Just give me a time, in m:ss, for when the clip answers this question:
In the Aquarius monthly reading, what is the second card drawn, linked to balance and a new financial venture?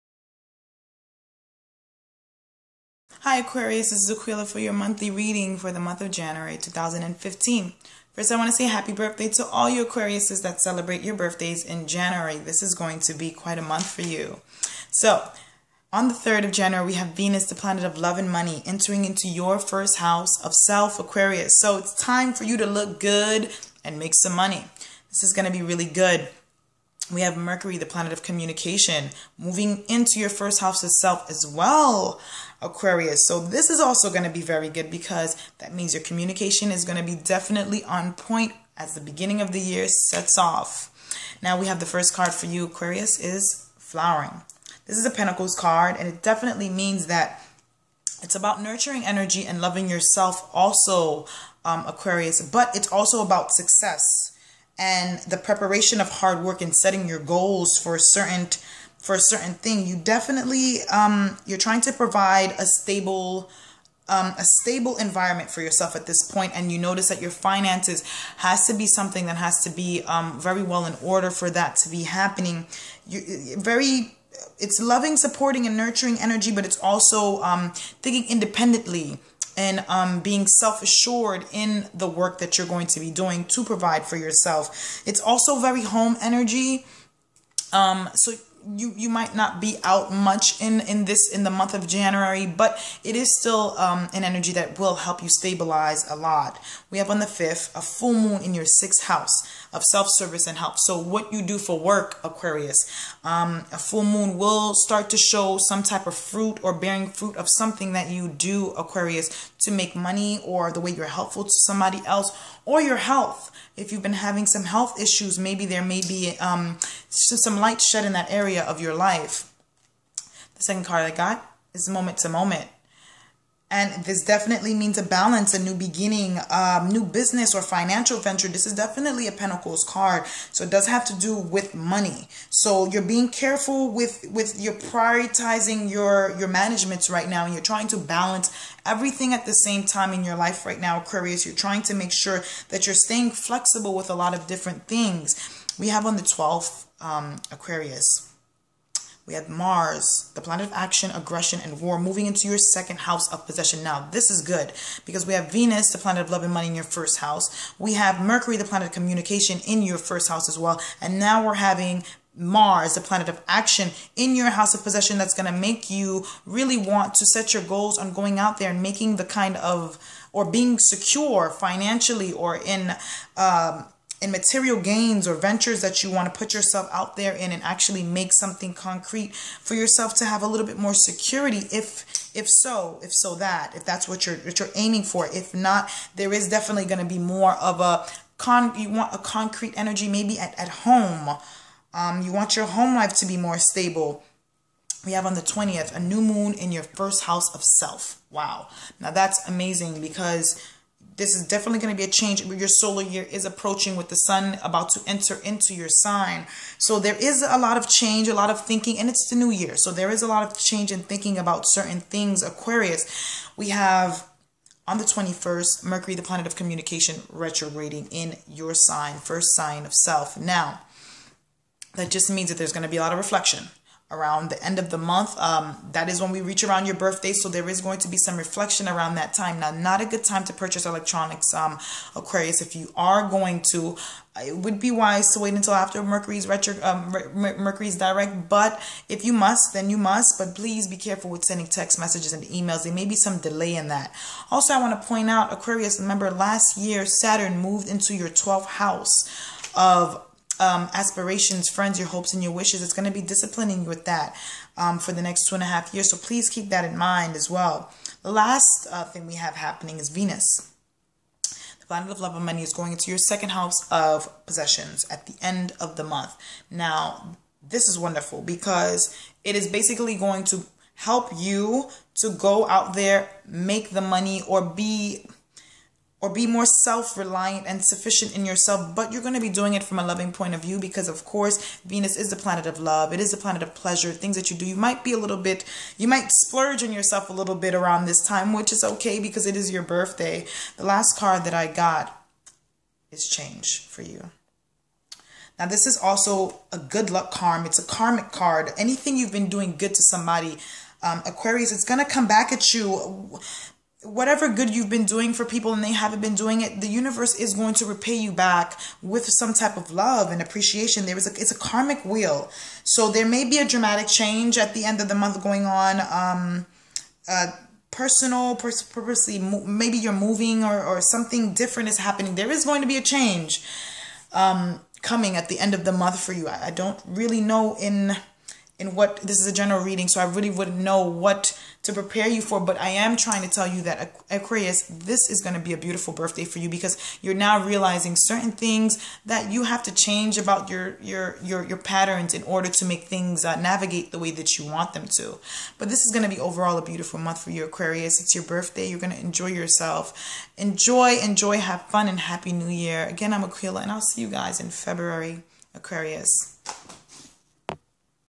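2:01.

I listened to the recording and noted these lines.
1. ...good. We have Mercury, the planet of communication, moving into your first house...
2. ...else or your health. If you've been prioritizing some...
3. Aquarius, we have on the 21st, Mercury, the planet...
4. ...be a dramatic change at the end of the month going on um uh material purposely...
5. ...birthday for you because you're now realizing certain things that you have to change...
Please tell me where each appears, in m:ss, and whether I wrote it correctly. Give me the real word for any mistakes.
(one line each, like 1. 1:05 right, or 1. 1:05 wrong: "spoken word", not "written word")
1. 0:25 right
2. 1:52 wrong: "having", not "prioritizing"
3. 3:32 right
4. 5:13 wrong: "personal", not "material"
5. 5:36 right.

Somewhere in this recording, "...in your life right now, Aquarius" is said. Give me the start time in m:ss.
2:20.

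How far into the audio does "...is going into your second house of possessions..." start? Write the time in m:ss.
4:22.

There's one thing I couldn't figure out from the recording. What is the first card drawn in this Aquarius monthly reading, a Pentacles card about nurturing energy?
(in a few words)
Flowering.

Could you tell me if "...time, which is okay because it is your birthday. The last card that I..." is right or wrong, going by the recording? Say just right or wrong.
right.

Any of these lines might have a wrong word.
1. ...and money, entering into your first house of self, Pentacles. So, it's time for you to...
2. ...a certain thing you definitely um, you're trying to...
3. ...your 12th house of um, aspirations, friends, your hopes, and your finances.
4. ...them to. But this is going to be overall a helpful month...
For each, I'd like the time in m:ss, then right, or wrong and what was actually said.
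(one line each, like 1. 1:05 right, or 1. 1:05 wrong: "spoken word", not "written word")
1. 0:18 wrong: "Aquarius", not "Pentacles"
2. 0:59 right
3. 4:08 wrong: "wishes", not "finances"
4. 5:44 wrong: "beautiful", not "helpful".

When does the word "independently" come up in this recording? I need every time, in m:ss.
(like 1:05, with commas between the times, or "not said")
1:18.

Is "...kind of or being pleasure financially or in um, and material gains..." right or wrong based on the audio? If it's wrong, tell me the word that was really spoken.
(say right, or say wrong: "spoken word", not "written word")
wrong: "secure", not "pleasure".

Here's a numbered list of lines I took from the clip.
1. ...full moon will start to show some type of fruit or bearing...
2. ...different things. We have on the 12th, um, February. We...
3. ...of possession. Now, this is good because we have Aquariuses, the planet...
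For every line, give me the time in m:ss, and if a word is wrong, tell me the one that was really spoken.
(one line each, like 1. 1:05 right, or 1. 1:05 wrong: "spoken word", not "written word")
1. 1:43 right
2. 2:24 wrong: "Aquarius", not "February"
3. 2:33 wrong: "Venus", not "Aquariuses".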